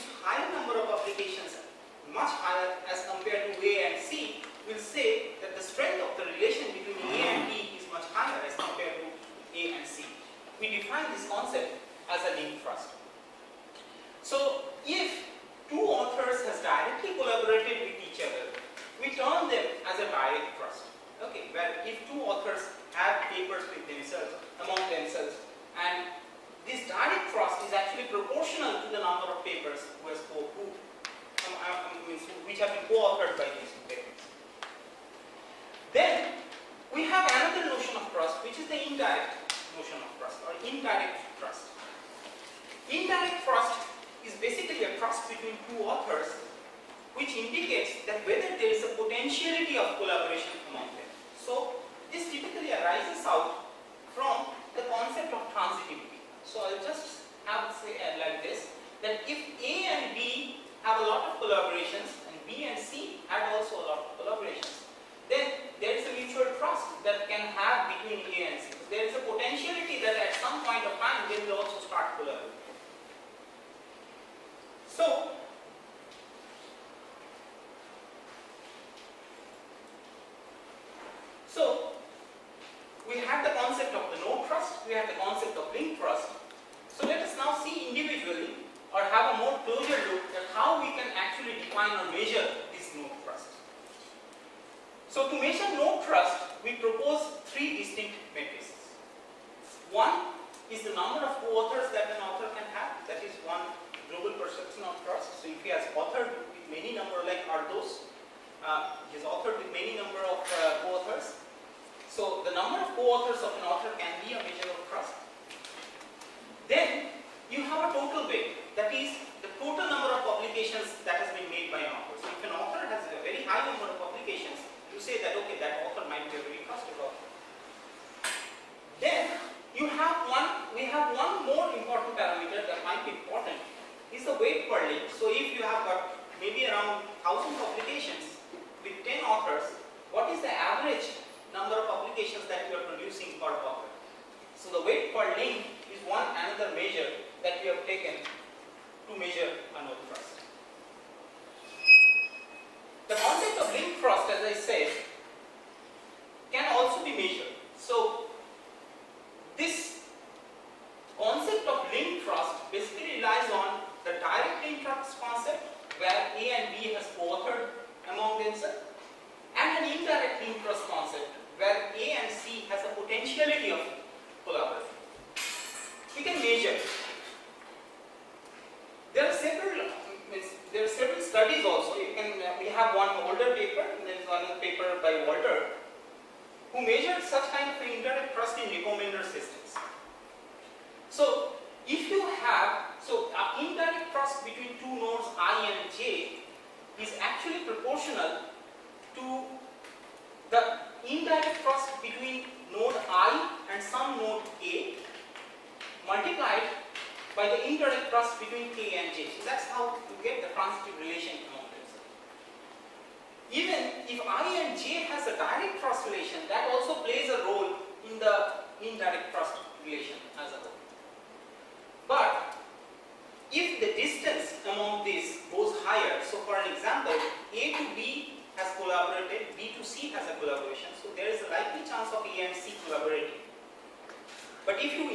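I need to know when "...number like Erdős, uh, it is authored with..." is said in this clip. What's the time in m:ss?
1:46.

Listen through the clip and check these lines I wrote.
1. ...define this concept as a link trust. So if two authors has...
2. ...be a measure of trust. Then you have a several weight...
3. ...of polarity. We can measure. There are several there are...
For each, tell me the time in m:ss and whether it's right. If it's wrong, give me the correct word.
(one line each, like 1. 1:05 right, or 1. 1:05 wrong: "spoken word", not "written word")
1. 0:10 right
2. 1:54 wrong: "total", not "several"
3. 2:53 right.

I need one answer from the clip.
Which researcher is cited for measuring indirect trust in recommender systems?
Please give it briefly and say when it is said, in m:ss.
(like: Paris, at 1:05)
Walter, at 3:05.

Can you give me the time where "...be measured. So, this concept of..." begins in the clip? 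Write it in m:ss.
2:37.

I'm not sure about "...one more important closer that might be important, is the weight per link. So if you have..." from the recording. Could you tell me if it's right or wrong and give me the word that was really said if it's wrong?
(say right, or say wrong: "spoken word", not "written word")
wrong: "parameter", not "closer".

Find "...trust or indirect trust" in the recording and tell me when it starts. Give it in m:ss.
0:40.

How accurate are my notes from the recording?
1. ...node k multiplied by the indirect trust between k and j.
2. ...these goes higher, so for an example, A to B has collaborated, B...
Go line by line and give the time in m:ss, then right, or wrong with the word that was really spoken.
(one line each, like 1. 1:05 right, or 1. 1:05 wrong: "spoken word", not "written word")
1. 3:24 right
2. 3:45 right.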